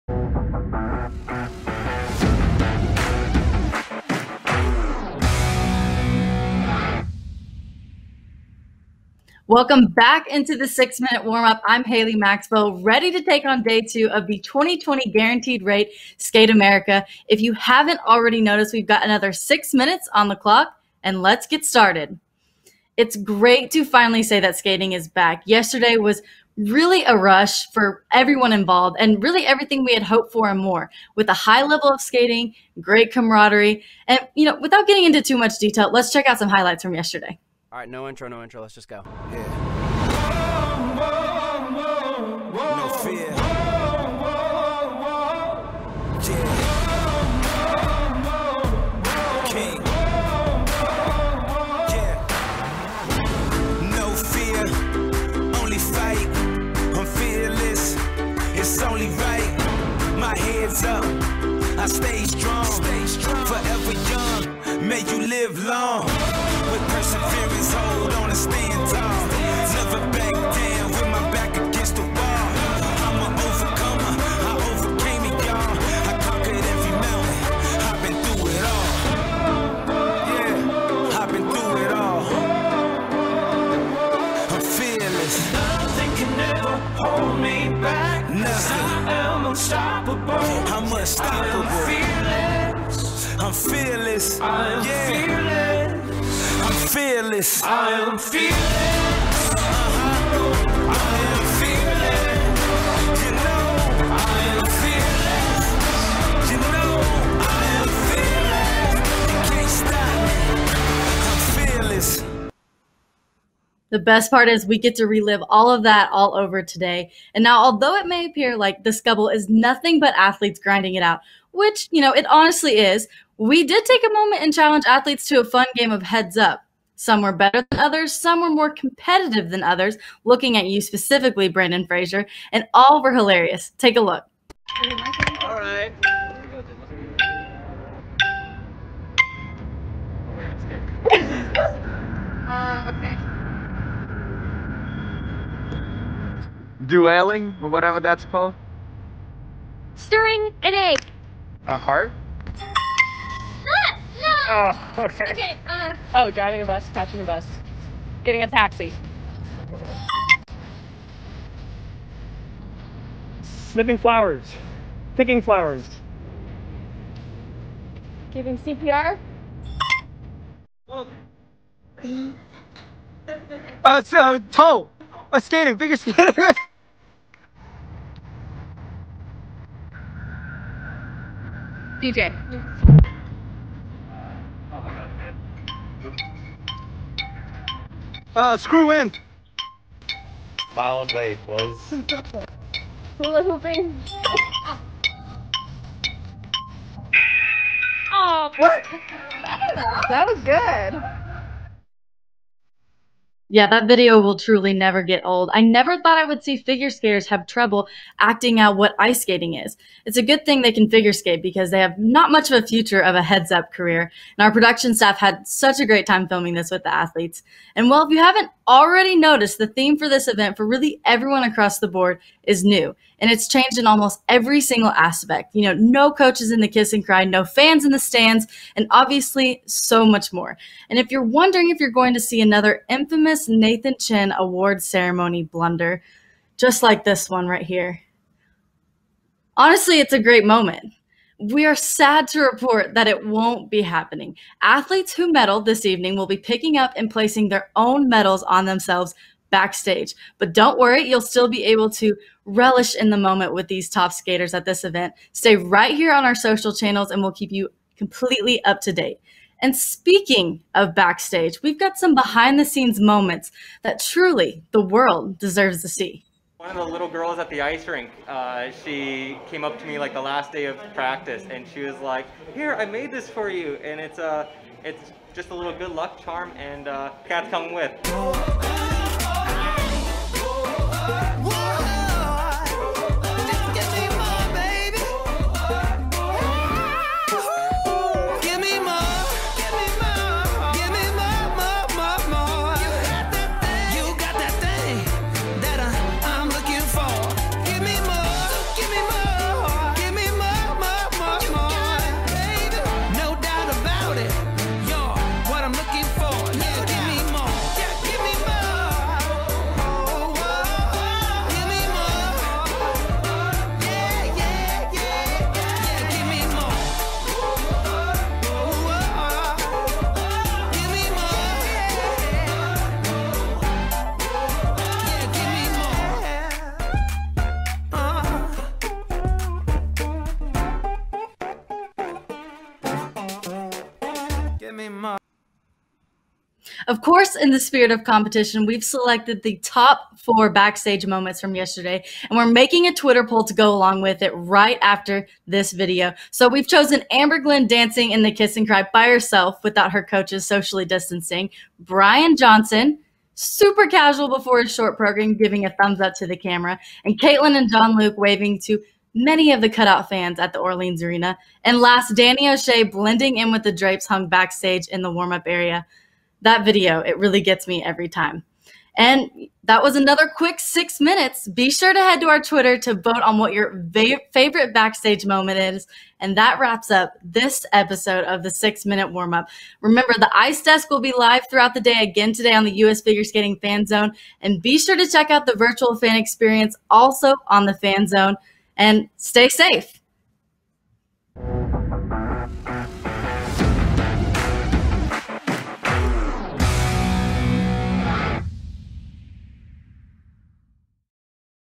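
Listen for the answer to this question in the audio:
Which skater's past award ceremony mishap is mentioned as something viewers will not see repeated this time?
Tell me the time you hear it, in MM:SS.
03:53.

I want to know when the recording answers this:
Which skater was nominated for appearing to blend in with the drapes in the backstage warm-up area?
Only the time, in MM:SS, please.
06:02.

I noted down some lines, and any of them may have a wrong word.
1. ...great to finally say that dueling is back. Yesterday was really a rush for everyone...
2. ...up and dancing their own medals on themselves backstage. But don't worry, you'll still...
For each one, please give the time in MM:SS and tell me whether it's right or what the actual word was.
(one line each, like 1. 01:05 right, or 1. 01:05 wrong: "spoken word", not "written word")
1. 00:23 wrong: "skating", not "dueling"
2. 04:06 wrong: "placing", not "dancing".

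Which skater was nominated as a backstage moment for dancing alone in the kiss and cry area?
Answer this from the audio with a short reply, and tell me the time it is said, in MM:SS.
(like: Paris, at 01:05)
Amber Glenn, at 05:47.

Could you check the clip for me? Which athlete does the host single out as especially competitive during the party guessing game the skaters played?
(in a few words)
Brandon Frazier.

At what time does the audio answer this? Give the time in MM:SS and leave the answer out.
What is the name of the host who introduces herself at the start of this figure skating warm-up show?
00:11.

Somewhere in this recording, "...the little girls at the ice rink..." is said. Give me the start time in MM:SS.
04:26.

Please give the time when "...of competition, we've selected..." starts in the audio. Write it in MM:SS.
05:37.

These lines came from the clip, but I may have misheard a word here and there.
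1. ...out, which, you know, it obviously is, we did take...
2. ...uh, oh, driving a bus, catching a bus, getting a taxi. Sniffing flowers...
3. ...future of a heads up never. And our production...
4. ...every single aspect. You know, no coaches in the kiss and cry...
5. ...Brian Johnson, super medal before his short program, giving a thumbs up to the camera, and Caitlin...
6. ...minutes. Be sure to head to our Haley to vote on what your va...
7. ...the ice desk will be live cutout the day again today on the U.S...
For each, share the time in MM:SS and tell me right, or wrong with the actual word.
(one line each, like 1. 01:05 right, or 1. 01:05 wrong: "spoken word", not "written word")
1. 02:01 wrong: "honestly", not "obviously"
2. 02:35 right
3. 03:32 wrong: "career", not "never"
4. 03:44 right
5. 05:51 wrong: "casual", not "medal"
6. 06:10 wrong: "Twitter", not "Haley"
7. 06:20 wrong: "throughout", not "cutout".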